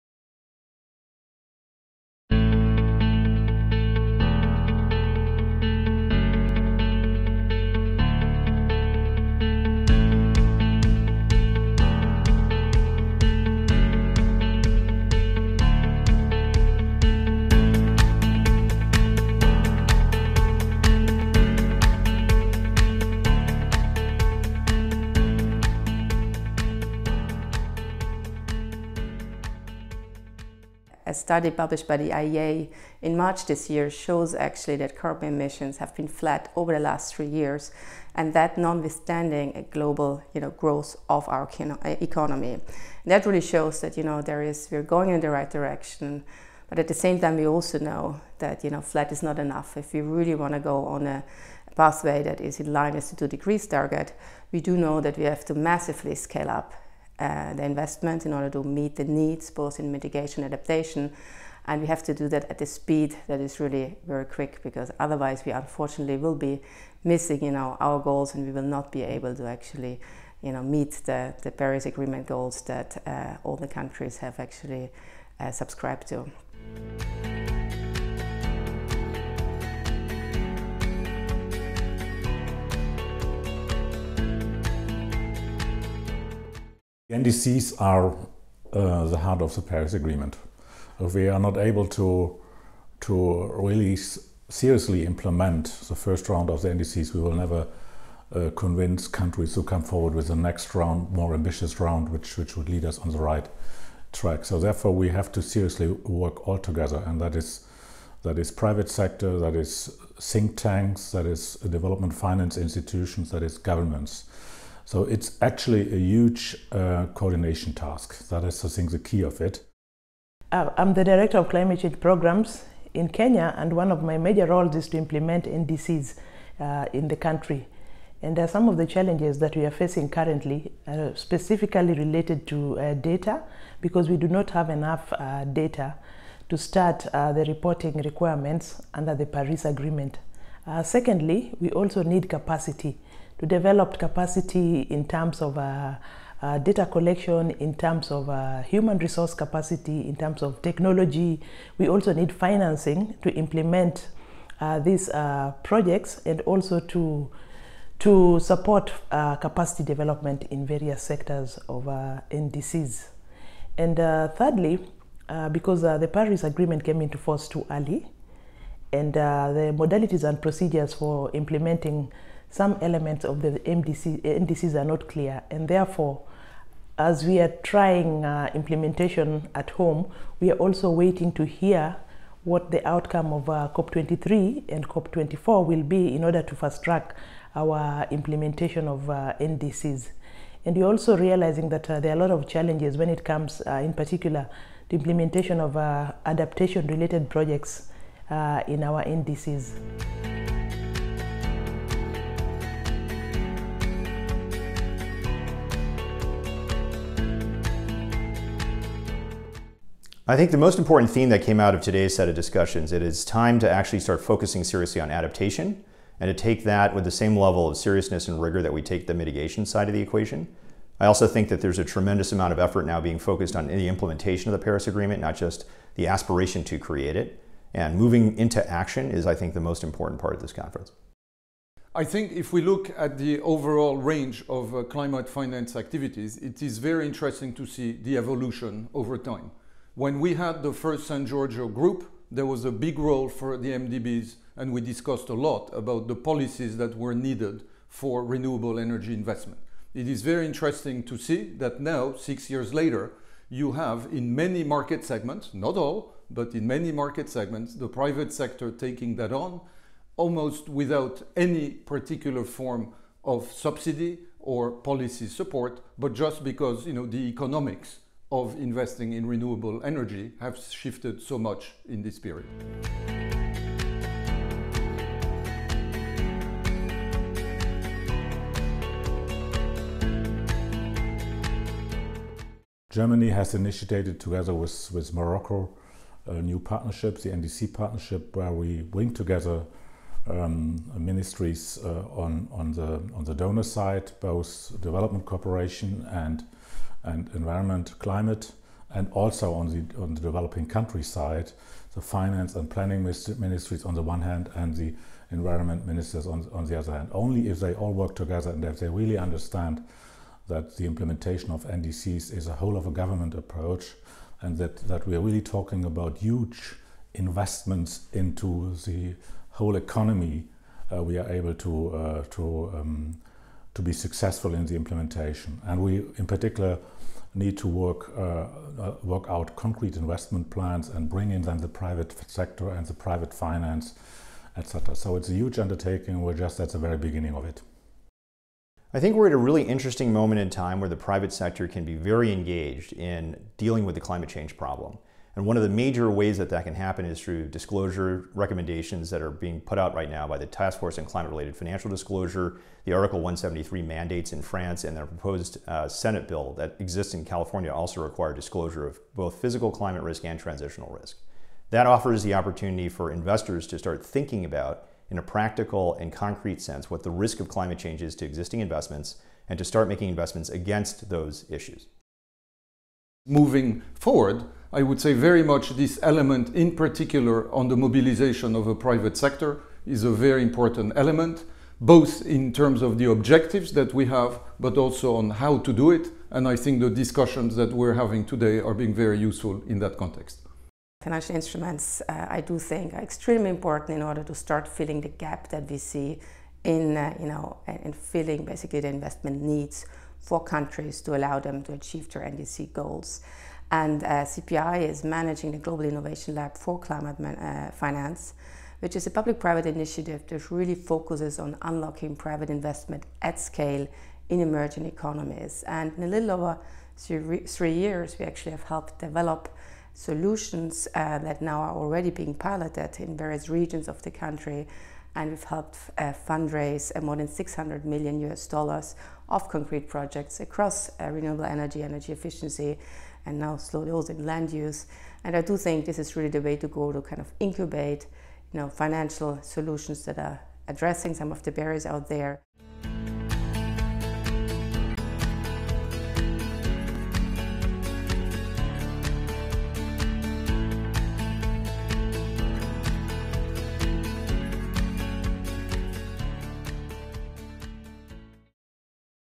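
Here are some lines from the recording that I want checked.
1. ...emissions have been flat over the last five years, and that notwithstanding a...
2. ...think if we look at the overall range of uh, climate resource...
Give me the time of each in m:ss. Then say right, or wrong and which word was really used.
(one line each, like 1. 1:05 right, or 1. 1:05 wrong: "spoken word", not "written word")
1. 0:35 wrong: "three", not "five"
2. 3:52 wrong: "finance", not "resource".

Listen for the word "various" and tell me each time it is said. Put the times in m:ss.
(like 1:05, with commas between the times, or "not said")
2:40, 7:03.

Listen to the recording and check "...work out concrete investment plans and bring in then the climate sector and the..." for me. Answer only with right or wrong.
wrong.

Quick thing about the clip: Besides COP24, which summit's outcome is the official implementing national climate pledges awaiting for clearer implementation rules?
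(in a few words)
COP23.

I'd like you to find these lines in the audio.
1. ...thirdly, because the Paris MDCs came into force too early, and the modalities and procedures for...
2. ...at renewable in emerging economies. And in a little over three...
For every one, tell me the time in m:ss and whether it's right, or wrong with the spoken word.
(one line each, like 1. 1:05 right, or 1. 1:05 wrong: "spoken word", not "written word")
1. 2:43 wrong: "Agreement", not "MDCs"
2. 6:53 wrong: "scale", not "renewable".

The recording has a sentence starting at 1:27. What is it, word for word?
The NDCs are uh, the heart of the Paris Agreement.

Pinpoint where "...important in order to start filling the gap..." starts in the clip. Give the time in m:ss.
6:33.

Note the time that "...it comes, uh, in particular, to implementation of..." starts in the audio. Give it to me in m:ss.
3:13.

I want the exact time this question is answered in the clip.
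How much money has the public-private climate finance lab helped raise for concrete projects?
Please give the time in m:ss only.
7:07.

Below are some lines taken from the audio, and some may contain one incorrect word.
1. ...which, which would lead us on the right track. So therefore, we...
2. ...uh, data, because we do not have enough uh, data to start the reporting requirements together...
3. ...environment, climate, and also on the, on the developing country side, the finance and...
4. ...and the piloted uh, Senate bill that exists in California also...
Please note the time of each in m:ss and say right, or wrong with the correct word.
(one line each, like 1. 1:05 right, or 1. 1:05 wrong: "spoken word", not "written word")
1. 1:42 right
2. 2:12 wrong: "under", not "together"
3. 4:57 right
4. 5:54 wrong: "proposed", not "piloted".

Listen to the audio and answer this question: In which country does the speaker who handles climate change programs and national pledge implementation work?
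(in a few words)
Kenya.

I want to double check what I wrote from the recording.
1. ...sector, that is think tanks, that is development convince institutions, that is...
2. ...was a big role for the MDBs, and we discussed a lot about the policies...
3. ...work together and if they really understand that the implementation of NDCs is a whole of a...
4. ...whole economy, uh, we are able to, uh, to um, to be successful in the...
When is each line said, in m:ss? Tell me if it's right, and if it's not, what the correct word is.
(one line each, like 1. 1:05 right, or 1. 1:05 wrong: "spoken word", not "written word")
1. 1:48 wrong: "finance", not "convince"
2. 4:02 right
3. 5:07 right
4. 5:19 right.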